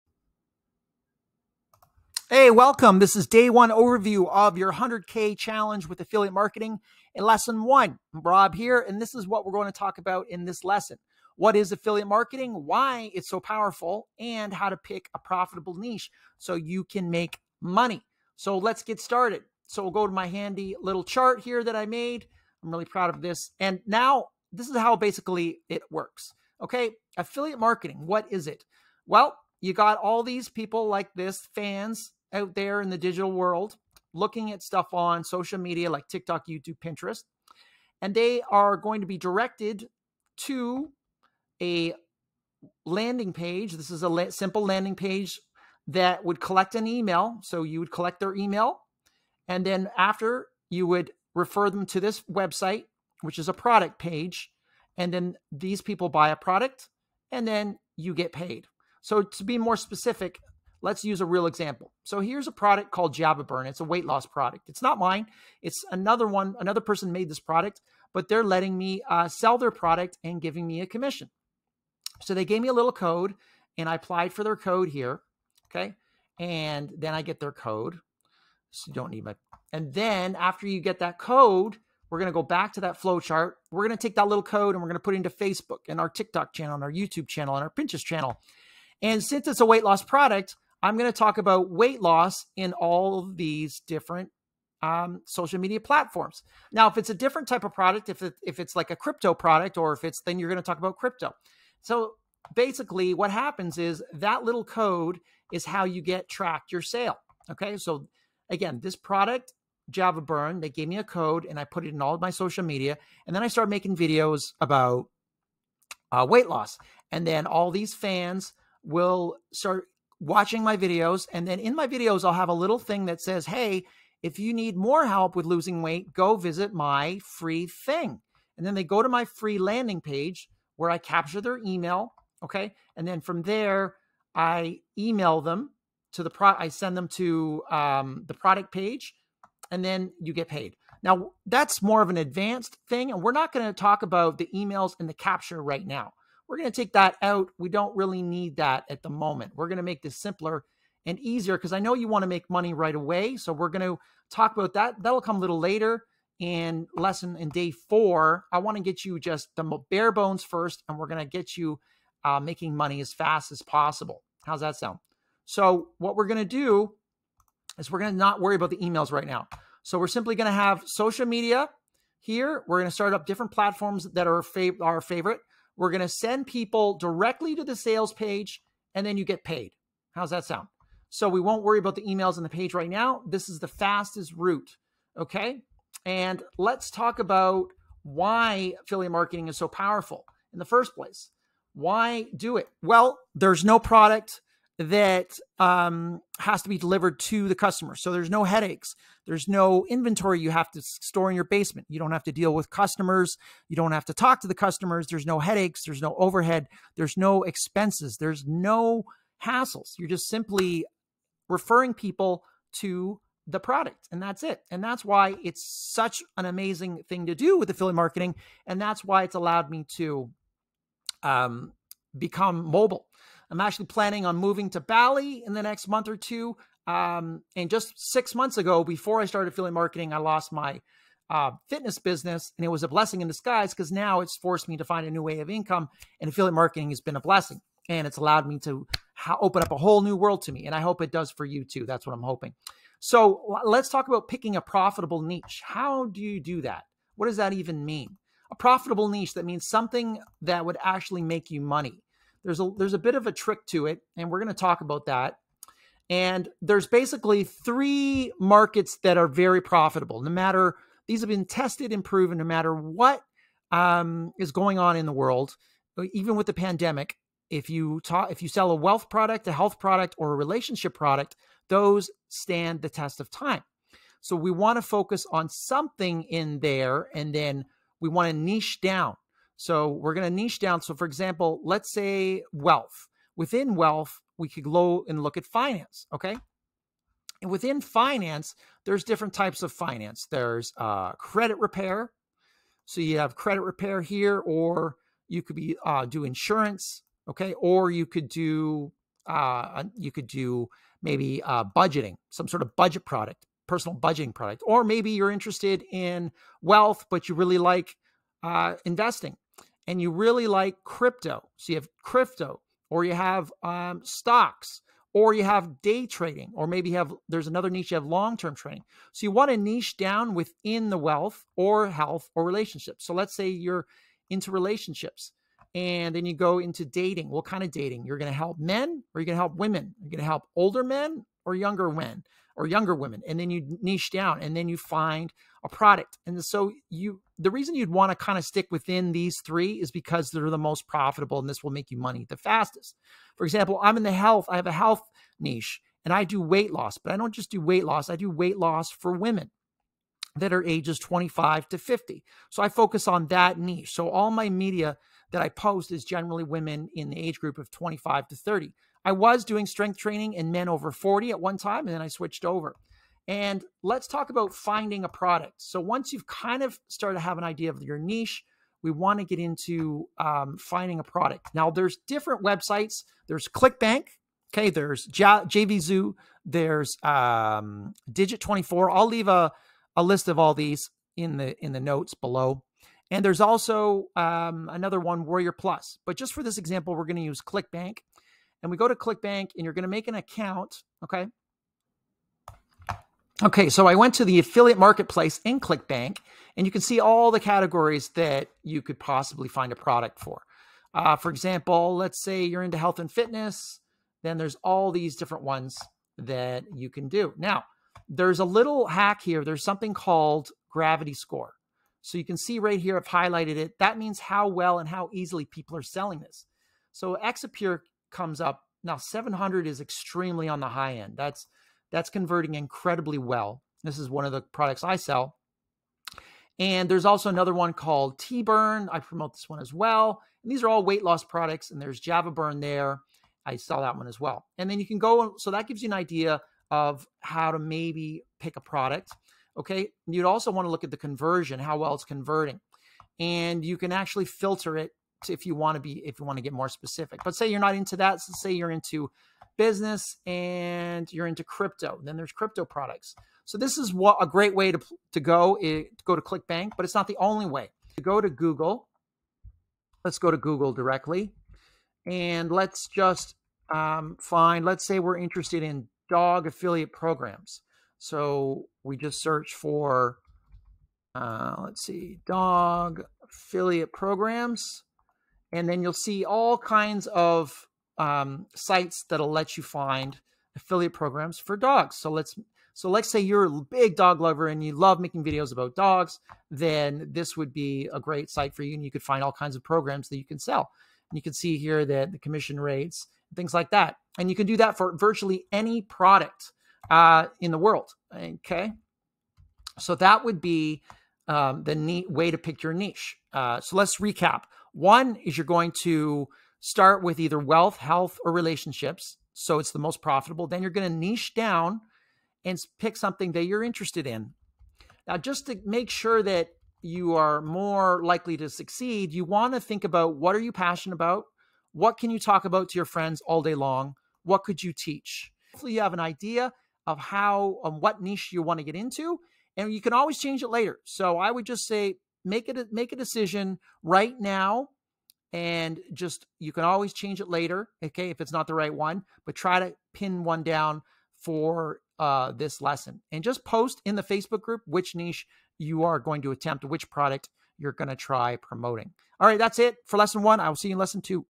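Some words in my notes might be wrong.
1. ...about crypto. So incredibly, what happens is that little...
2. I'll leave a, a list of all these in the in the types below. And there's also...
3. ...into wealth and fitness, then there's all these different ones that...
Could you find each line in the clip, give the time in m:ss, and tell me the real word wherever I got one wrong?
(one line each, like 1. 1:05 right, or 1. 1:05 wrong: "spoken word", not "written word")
1. 1:40 wrong: "basically", not "incredibly"
2. 6:18 wrong: "notes", not "types"
3. 6:42 wrong: "health", not "wealth".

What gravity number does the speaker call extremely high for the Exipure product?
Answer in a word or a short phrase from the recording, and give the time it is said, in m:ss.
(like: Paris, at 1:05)
700, at 6:58.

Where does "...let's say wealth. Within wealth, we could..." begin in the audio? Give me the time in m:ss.
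4:41.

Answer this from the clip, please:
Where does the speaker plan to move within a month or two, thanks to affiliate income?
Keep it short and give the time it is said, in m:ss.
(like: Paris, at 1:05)
Bali, at 3:44.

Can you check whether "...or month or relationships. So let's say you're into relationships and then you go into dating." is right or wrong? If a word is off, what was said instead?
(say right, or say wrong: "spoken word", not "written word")
wrong: "health", not "month".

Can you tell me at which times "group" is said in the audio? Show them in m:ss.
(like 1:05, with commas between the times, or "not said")
5:57, 9:04.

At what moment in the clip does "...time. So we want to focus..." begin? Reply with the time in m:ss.
4:33.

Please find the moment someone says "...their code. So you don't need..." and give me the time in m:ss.
1:17.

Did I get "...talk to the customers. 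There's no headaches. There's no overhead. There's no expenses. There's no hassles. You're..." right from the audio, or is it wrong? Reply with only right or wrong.
right.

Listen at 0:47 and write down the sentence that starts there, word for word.
So you would collect their email, and then after you would refer them to this website, which is a product page.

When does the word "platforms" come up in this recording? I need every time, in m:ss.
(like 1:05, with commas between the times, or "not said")
1:35, 2:53.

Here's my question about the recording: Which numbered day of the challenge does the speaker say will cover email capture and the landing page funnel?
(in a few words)
Day 4.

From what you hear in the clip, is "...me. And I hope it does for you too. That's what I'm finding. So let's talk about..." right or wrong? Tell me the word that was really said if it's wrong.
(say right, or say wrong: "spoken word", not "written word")
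wrong: "hoping", not "finding".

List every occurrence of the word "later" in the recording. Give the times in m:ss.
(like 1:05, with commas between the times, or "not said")
2:35, 8:50, 8:57.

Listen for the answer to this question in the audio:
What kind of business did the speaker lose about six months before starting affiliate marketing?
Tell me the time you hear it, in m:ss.
3:51.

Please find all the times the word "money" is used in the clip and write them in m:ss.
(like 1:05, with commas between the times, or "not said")
0:17, 2:32, 2:42, 4:11, 5:41.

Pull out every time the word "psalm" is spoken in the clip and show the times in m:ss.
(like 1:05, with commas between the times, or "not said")
not said.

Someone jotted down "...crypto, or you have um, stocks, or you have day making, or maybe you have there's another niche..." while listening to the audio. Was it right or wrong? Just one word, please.
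wrong.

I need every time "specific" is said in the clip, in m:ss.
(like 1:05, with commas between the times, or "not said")
0:59, 7:26.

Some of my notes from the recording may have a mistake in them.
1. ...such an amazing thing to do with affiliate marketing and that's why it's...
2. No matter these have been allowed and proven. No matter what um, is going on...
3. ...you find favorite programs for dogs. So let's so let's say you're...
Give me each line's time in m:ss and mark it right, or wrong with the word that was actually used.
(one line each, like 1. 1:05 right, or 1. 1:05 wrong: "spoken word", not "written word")
1. 3:35 right
2. 4:20 wrong: "tested", not "allowed"
3. 7:59 wrong: "affiliate", not "favorite".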